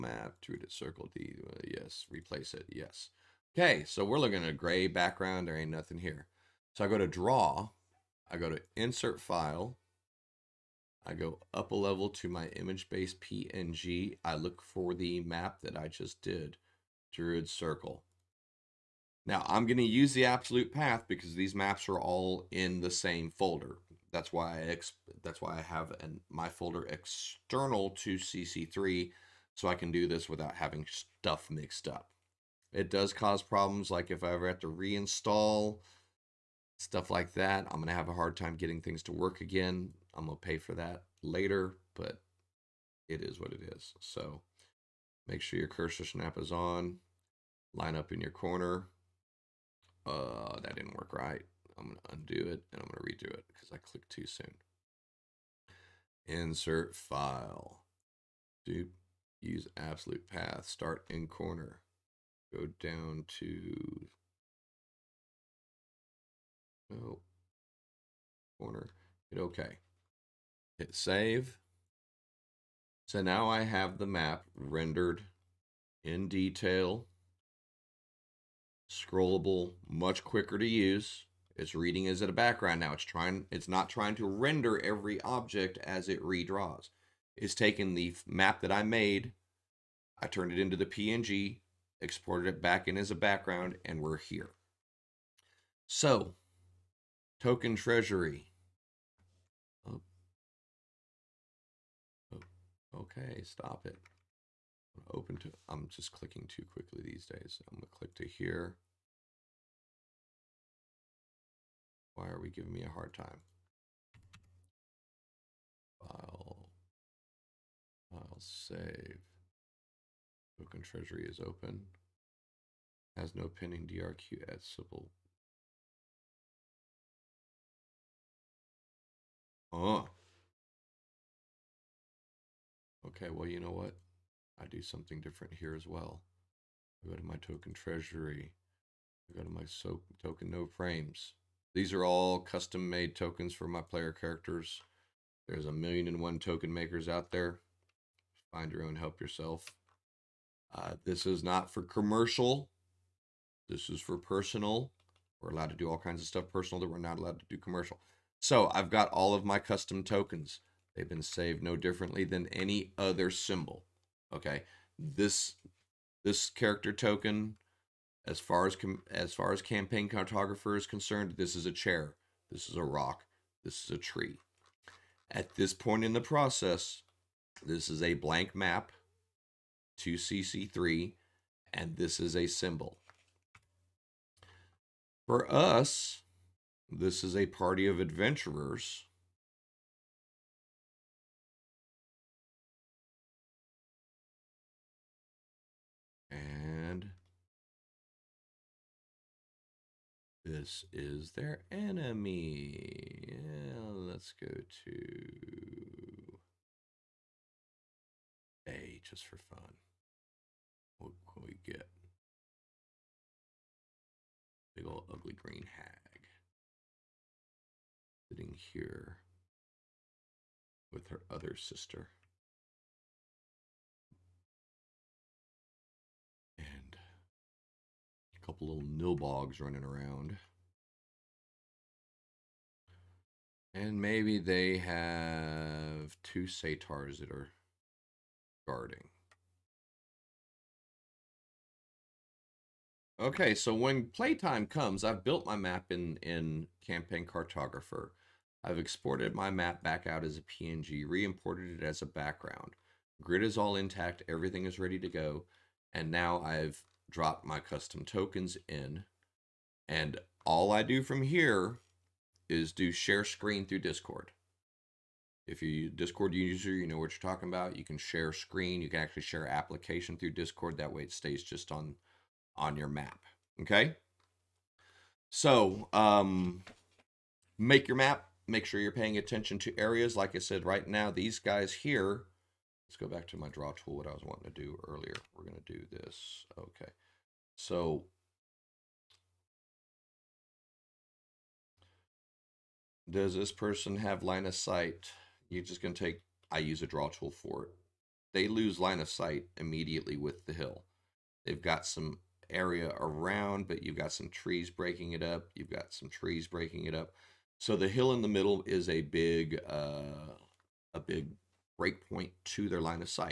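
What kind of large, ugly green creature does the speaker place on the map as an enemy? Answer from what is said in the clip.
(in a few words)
hag.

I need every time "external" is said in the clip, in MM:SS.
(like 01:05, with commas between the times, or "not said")
00:26.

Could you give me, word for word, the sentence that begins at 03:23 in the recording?
Yeah, let's go to A just for fun.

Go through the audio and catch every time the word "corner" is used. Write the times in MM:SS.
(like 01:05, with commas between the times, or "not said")
00:48, 01:01, 01:08.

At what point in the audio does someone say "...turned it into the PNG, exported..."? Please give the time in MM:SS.
01:30.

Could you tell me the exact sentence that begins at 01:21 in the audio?
It's reading as a background now.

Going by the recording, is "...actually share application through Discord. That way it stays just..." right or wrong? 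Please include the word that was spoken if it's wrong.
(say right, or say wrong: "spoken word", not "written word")
right.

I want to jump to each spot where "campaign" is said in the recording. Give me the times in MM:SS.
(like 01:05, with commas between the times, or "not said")
02:49, 04:06.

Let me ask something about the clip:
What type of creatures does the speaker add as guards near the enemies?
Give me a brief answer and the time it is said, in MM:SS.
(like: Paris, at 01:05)
satyrs, at 03:56.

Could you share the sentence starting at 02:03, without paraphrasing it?
Has no pending DRQ at Sybil.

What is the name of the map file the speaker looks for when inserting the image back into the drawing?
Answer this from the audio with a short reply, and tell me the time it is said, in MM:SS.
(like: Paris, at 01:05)
Druid Circle, at 00:17.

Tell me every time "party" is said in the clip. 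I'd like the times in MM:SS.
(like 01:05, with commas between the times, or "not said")
03:07.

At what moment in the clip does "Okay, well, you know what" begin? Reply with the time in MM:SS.
02:13.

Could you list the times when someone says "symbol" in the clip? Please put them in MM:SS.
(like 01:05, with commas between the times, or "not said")
02:43, 03:02.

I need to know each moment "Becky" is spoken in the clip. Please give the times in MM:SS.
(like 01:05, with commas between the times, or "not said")
not said.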